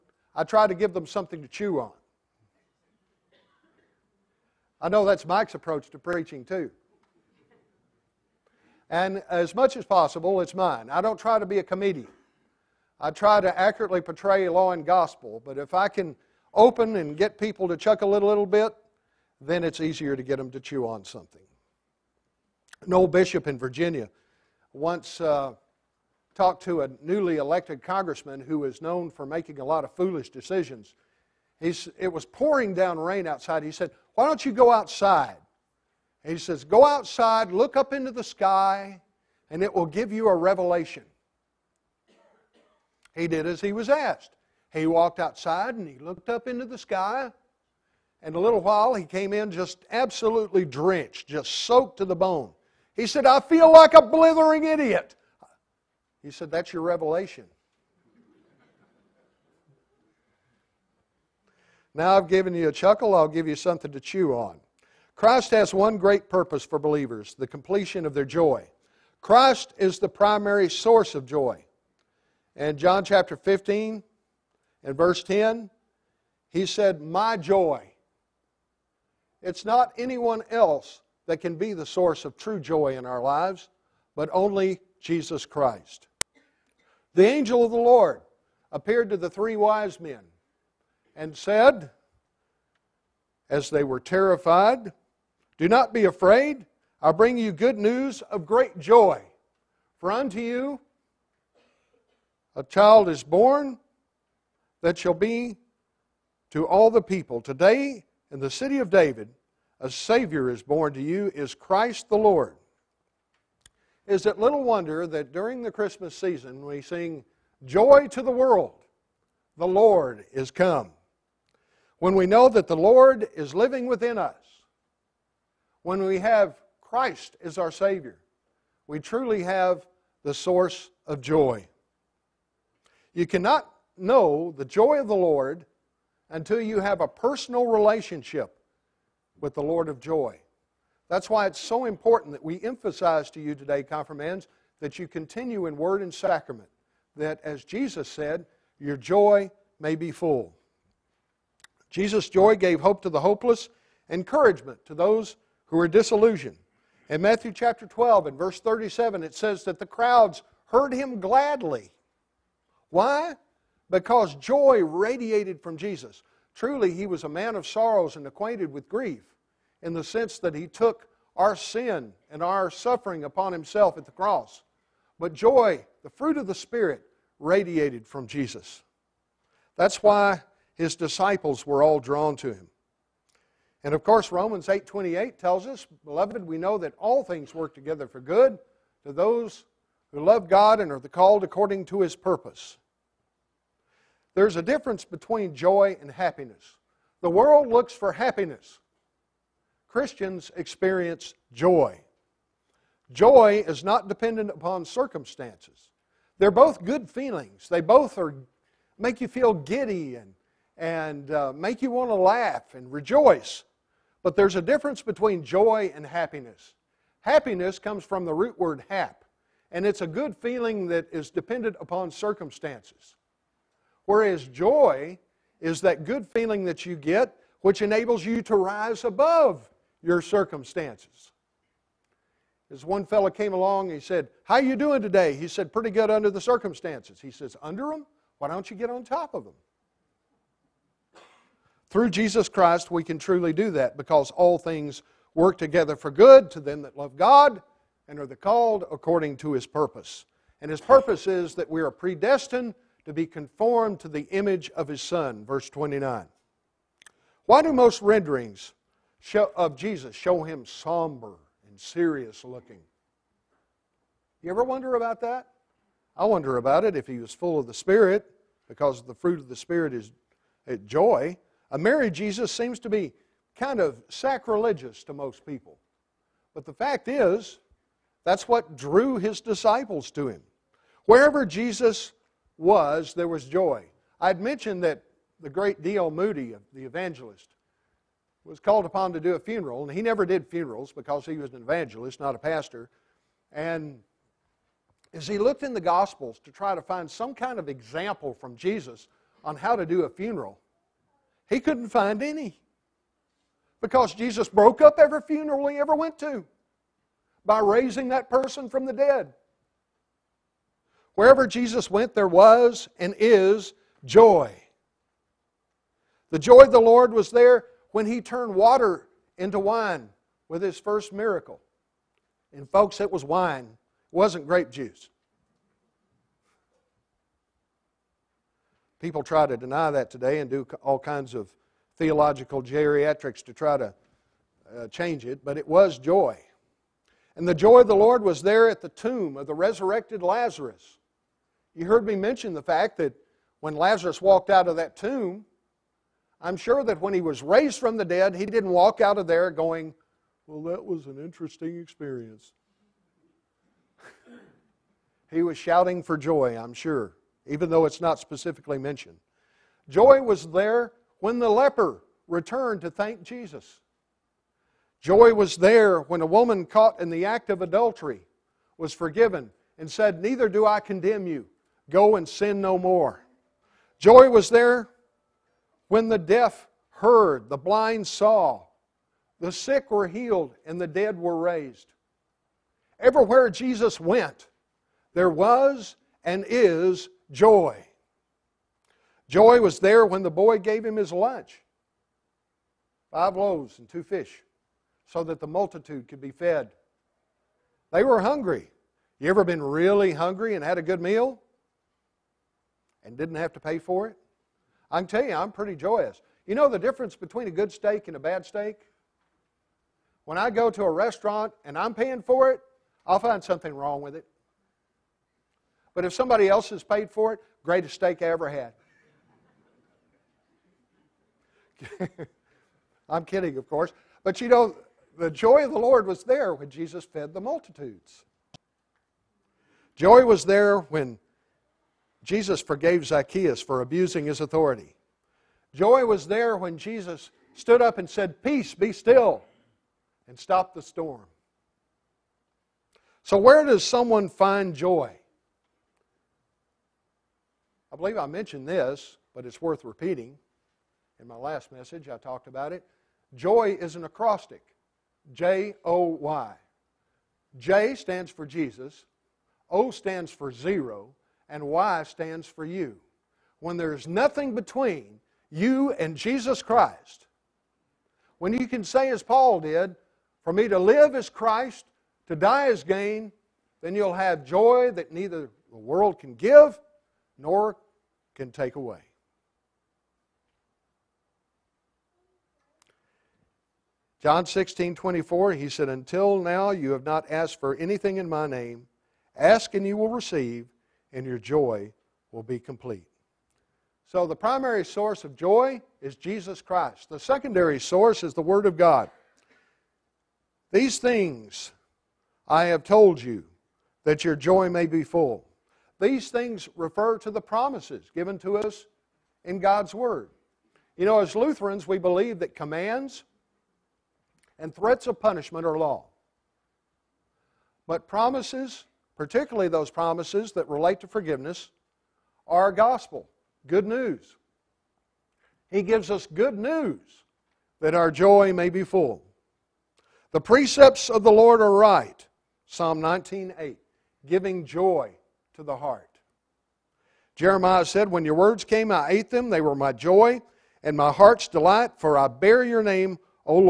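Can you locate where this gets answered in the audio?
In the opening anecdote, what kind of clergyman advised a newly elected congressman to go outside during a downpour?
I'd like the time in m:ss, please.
0:23.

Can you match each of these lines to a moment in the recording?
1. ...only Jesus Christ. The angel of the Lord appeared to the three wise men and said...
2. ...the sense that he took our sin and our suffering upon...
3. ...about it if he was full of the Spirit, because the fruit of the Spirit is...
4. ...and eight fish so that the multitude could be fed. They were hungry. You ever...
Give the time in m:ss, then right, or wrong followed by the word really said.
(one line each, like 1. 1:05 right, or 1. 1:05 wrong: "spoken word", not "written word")
1. 1:24 right
2. 2:49 right
3. 4:26 right
4. 6:33 wrong: "two", not "eight".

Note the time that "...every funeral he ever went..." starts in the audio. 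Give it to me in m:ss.
5:04.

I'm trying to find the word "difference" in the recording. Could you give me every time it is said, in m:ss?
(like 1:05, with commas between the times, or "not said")
3:14, 3:34, 6:46.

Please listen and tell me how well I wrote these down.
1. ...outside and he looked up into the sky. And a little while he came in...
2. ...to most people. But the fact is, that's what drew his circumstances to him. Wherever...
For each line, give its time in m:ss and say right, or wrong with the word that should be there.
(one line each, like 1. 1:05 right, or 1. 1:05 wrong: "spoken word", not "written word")
1. 0:45 right
2. 4:35 wrong: "disciples", not "circumstances".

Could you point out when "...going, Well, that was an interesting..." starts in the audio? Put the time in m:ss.
5:49.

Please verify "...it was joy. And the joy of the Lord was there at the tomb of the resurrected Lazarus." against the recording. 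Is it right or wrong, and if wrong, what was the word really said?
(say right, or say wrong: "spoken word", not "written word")
right.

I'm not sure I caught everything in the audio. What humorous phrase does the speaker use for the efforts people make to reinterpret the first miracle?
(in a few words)
theological geriatrics.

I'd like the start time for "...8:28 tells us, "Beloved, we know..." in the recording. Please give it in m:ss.
3:04.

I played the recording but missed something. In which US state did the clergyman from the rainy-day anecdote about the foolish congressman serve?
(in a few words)
Virginia.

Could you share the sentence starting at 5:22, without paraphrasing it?
And, folks, it was wine, it wasn't grape juice.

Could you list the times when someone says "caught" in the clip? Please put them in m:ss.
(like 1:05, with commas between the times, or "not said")
6:06.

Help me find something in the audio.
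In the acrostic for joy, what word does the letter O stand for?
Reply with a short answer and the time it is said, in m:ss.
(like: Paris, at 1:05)
zero, at 7:40.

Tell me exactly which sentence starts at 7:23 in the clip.
So, where does someone find joy?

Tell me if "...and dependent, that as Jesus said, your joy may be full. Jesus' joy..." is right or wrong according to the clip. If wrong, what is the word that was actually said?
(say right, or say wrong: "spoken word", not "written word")
wrong: "sacrament", not "dependent".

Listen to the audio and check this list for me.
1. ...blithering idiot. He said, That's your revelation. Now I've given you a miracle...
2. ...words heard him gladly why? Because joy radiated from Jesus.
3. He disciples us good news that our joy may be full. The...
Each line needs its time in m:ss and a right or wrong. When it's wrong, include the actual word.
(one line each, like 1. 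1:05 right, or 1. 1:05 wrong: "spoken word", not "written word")
1. 0:54 wrong: "chuckle", not "miracle"
2. 2:39 wrong: "crowds", not "words"
3. 8:45 wrong: "gives", not "disciples".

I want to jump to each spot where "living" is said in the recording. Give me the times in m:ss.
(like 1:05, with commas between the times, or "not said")
2:03.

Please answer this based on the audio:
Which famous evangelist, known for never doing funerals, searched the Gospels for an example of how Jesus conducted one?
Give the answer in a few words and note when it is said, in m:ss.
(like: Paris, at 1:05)
D.L. Moody, at 4:45.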